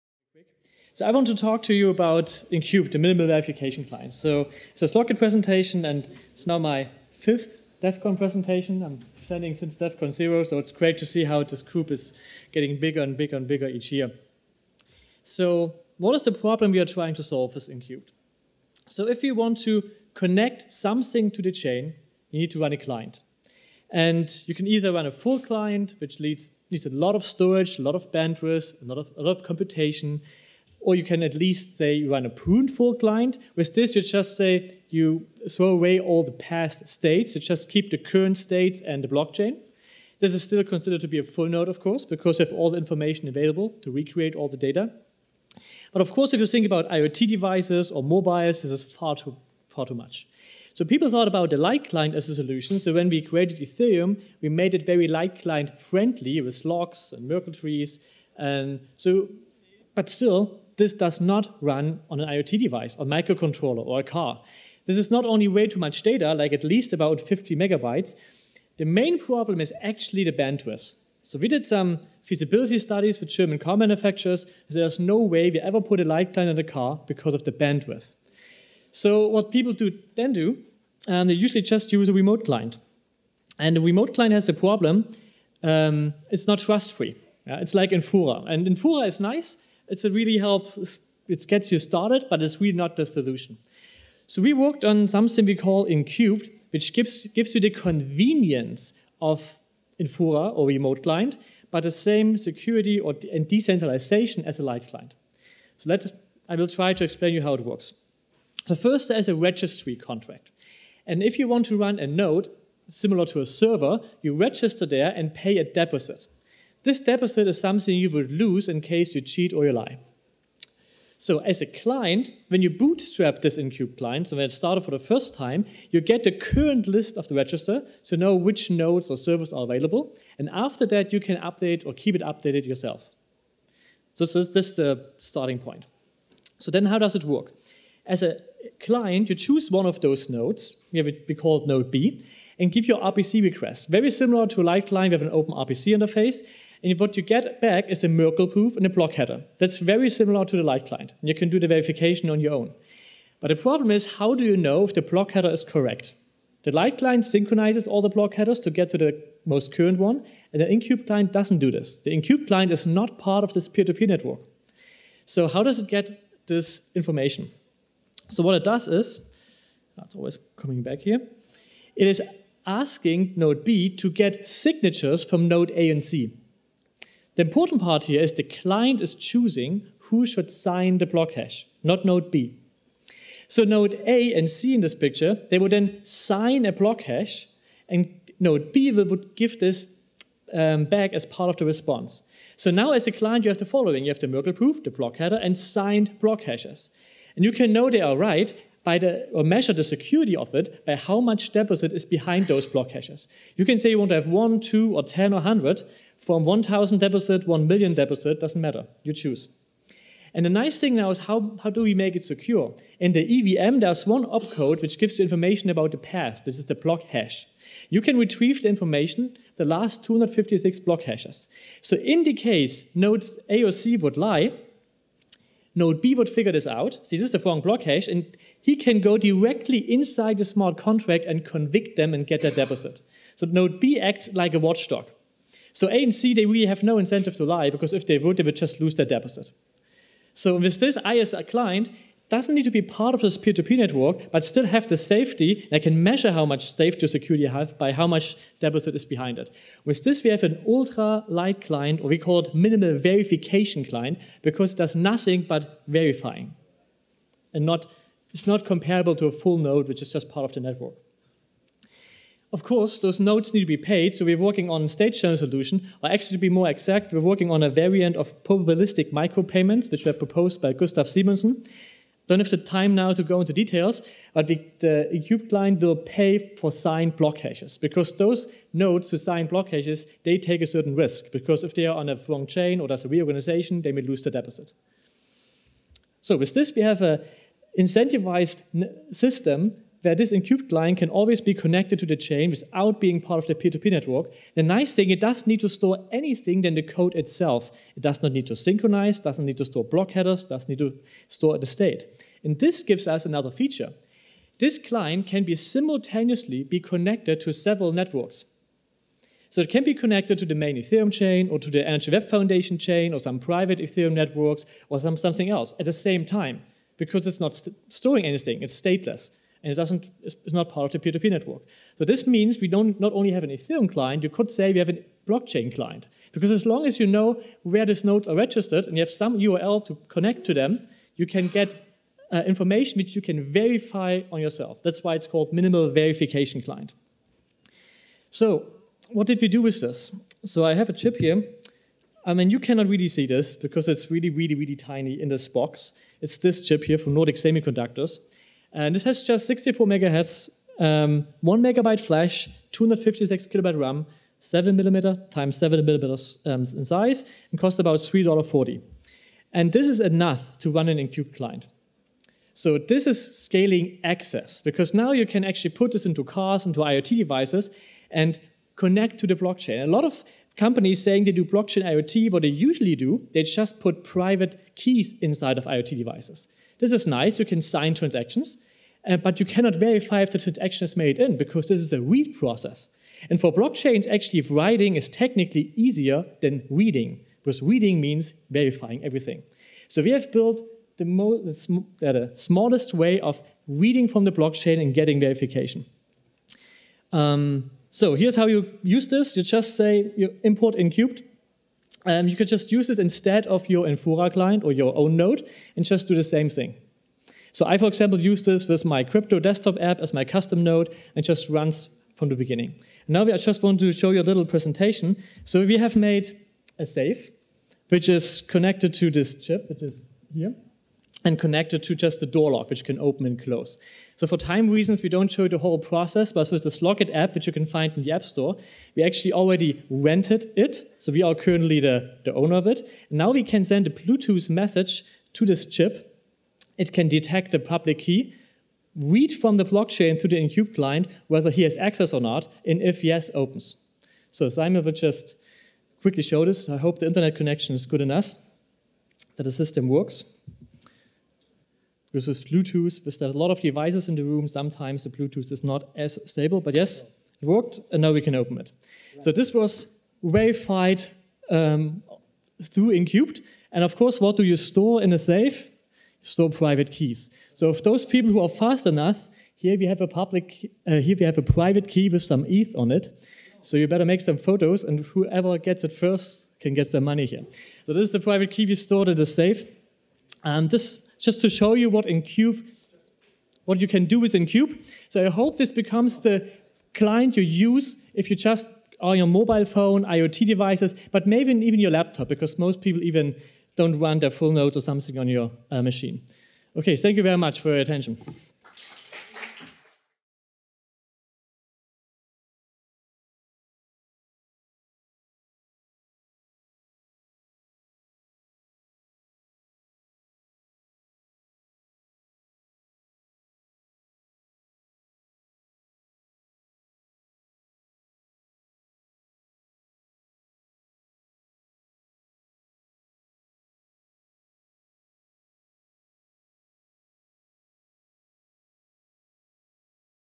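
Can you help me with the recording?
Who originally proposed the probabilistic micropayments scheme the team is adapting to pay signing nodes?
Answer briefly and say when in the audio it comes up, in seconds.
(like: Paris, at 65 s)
Gustav Simonsson, at 270 s.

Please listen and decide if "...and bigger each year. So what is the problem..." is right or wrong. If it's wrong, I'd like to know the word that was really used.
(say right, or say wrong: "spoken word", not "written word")
right.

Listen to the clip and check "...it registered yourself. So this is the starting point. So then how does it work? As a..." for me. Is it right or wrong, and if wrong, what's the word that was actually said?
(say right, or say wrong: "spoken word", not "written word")
wrong: "updated", not "registered".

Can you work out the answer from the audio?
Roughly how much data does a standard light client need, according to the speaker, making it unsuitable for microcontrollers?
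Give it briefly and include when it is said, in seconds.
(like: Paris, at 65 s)
50 megabytes, at 67 s.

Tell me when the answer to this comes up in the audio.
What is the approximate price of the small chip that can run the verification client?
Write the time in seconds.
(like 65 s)
357 s.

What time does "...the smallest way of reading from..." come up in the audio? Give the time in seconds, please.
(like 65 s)
392 s.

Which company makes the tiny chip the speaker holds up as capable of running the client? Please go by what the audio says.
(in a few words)
Nordic Semiconductors.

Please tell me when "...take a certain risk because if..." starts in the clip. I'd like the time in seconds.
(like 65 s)
280 s.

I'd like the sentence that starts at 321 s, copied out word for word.
So this means we don't not only have an Ethereum client, you could say we have a blockchain client.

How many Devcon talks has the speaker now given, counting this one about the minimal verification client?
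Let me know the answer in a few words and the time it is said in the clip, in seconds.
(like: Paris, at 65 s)
5, at 7 s.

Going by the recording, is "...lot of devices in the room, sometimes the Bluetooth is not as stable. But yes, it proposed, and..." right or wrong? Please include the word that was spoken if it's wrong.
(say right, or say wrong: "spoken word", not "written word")
wrong: "worked", not "proposed".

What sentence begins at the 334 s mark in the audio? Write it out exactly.
That's why it's called minimal verification client.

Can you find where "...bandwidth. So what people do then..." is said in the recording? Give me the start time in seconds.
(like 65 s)
77 s.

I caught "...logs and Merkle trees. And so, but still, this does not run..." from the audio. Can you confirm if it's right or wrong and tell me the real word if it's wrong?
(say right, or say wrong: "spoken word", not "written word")
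right.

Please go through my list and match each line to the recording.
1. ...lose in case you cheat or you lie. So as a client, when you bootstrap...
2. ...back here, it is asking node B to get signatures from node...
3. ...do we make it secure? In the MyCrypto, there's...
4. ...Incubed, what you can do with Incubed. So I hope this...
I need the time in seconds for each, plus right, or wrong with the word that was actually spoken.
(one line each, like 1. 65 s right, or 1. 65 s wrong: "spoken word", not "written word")
1. 118 s right
2. 170 s right
3. 211 s wrong: "EVM", not "MyCrypto"
4. 482 s right.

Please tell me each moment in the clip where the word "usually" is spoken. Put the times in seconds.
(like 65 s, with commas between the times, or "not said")
81 s, 372 s.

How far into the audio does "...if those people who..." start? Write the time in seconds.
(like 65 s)
467 s.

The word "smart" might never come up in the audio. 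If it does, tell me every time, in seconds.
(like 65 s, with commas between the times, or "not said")
230 s.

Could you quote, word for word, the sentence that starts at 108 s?
So first there is a registry contract.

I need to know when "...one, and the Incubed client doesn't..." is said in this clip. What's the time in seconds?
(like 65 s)
159 s.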